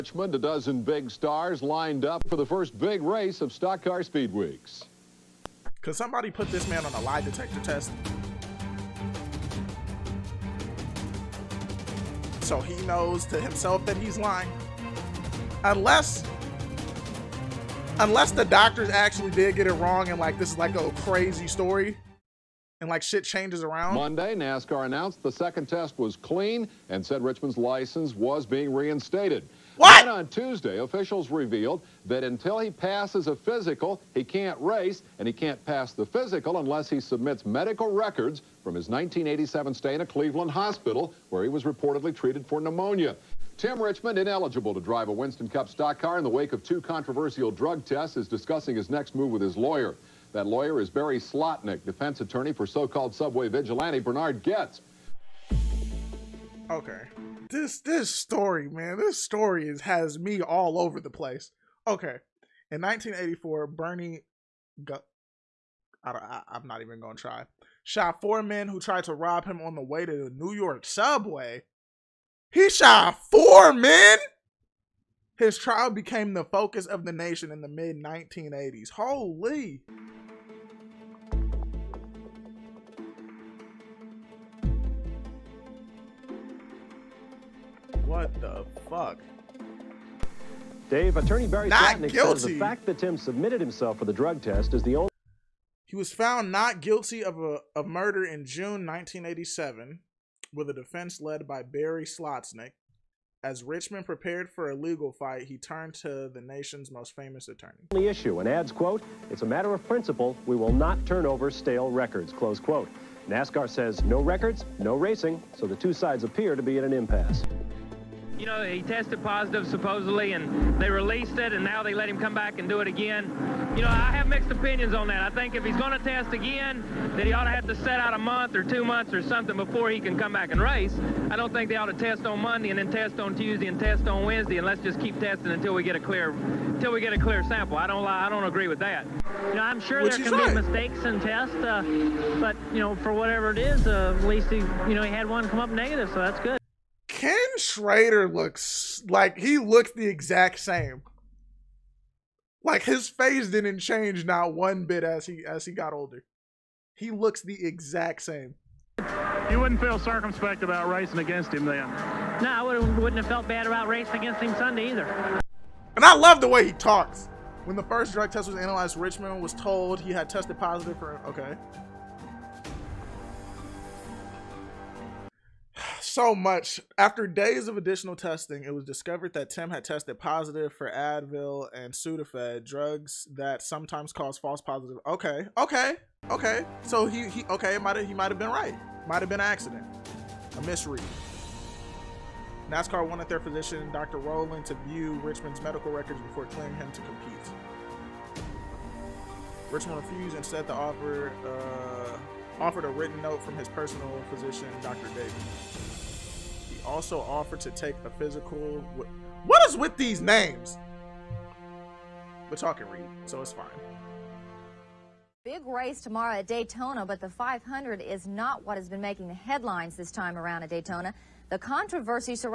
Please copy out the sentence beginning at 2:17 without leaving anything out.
I don't, lie, I don't agree with that.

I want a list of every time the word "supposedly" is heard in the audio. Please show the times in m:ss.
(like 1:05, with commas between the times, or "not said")
1:59.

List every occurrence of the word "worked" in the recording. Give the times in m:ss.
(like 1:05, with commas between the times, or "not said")
not said.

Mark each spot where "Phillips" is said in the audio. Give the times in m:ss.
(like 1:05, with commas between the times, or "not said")
not said.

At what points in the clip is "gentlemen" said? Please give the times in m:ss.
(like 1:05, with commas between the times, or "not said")
not said.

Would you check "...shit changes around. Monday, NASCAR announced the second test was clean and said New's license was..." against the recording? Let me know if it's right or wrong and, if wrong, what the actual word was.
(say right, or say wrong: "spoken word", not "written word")
wrong: "Richmond", not "New".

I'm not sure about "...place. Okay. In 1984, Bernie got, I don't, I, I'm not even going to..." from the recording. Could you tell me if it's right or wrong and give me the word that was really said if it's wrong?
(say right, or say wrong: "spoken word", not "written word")
right.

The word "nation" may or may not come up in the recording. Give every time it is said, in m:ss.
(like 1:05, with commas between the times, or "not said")
1:17, 1:46.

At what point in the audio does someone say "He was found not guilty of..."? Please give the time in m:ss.
1:35.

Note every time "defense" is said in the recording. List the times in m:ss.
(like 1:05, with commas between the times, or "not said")
0:51, 1:40.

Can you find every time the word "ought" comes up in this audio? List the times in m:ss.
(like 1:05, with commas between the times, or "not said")
2:07, 2:11.